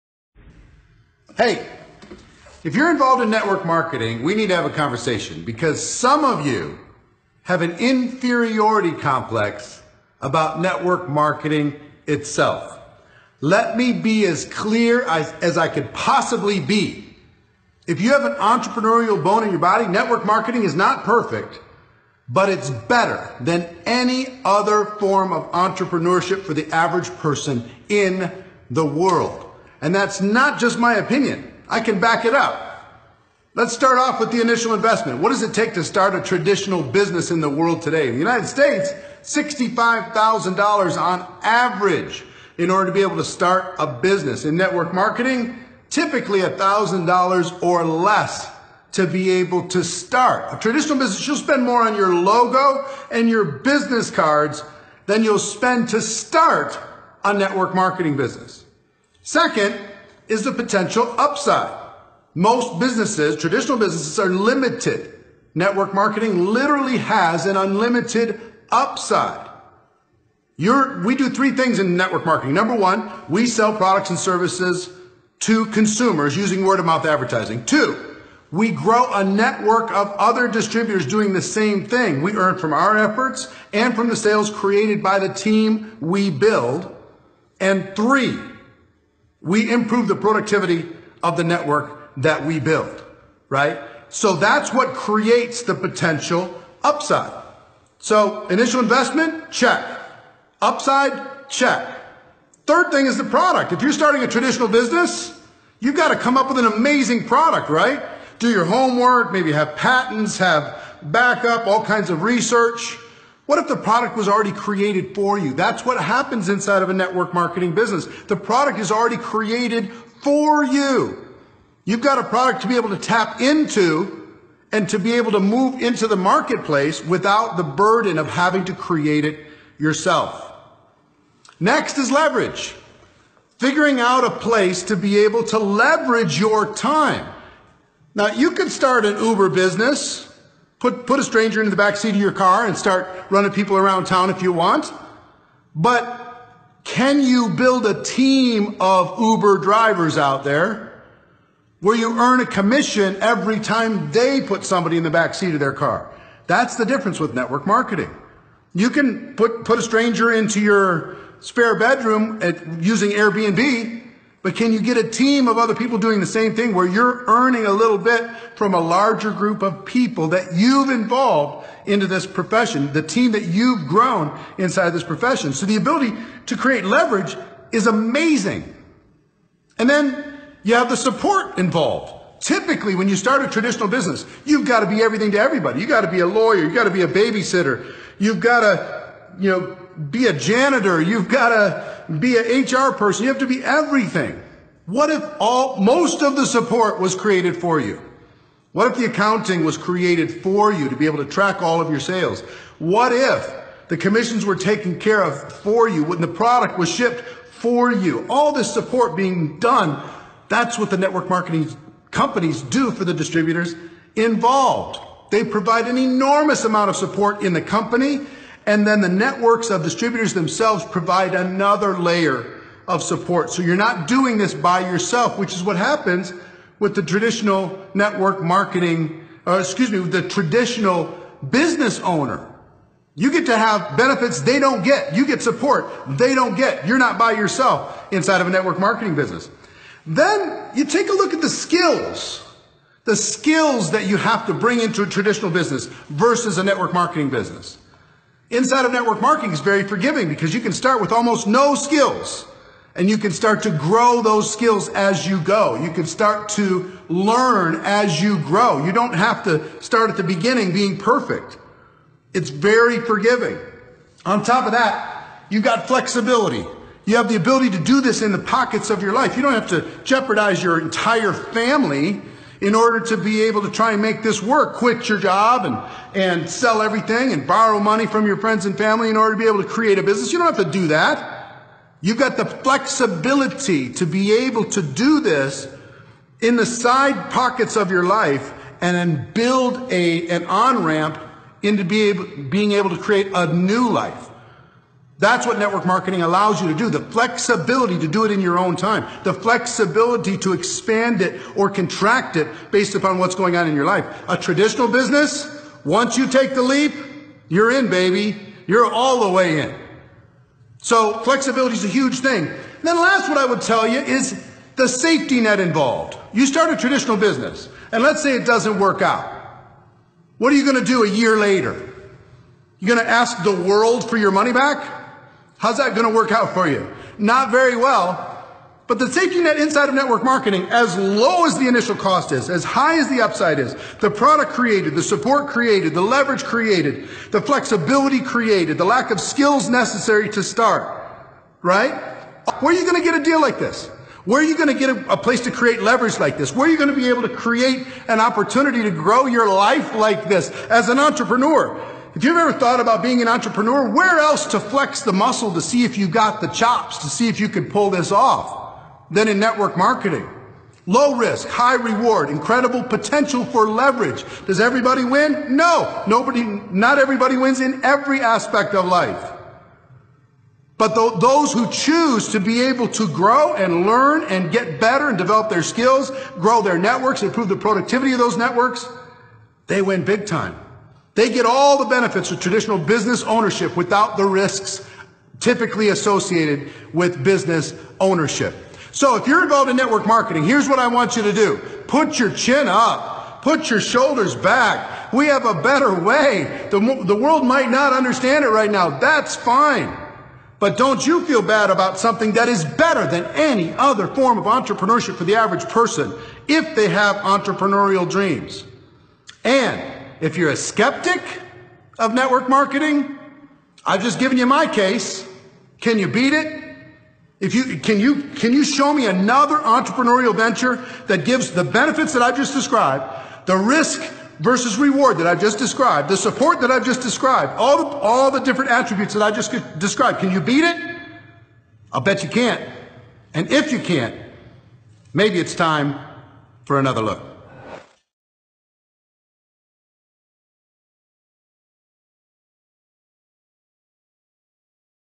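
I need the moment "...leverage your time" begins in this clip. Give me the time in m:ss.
2:15.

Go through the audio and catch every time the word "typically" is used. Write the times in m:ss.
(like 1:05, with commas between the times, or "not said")
0:45, 3:02, 6:25.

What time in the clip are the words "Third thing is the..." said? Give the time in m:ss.
1:42.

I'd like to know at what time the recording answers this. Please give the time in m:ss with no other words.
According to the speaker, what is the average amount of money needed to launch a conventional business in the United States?
0:39.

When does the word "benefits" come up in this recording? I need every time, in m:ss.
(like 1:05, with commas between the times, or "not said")
3:53, 6:21, 7:01.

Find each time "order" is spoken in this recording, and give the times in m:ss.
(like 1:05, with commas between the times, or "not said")
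0:42, 4:32, 4:39.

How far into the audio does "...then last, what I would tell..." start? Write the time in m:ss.
5:12.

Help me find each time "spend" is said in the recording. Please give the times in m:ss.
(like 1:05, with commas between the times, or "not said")
0:51, 0:55.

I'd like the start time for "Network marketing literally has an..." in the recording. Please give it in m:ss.
1:05.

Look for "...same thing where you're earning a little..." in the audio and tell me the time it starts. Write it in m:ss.
2:46.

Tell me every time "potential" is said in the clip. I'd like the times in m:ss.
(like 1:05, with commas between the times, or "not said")
1:00, 1:35, 6:02.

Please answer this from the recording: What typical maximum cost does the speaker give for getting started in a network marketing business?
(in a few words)
$1,000.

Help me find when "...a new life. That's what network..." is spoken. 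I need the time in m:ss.
4:53.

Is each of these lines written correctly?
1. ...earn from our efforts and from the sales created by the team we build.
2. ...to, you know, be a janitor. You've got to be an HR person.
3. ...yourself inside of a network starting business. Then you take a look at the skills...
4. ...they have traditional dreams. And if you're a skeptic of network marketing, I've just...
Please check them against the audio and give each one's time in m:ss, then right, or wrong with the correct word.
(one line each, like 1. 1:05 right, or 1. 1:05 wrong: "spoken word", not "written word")
1. 1:22 right
2. 3:08 right
3. 3:57 wrong: "marketing", not "starting"
4. 6:46 wrong: "entrepreneurial", not "traditional".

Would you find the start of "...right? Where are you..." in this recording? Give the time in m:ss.
5:41.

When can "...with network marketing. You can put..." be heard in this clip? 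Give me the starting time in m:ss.
2:37.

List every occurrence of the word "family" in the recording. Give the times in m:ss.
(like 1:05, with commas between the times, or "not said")
4:31, 4:38.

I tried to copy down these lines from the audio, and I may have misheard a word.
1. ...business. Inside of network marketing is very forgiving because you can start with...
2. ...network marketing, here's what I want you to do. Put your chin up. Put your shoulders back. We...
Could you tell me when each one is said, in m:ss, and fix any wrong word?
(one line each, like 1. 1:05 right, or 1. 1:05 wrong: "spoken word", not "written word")
1. 4:07 right
2. 6:29 right.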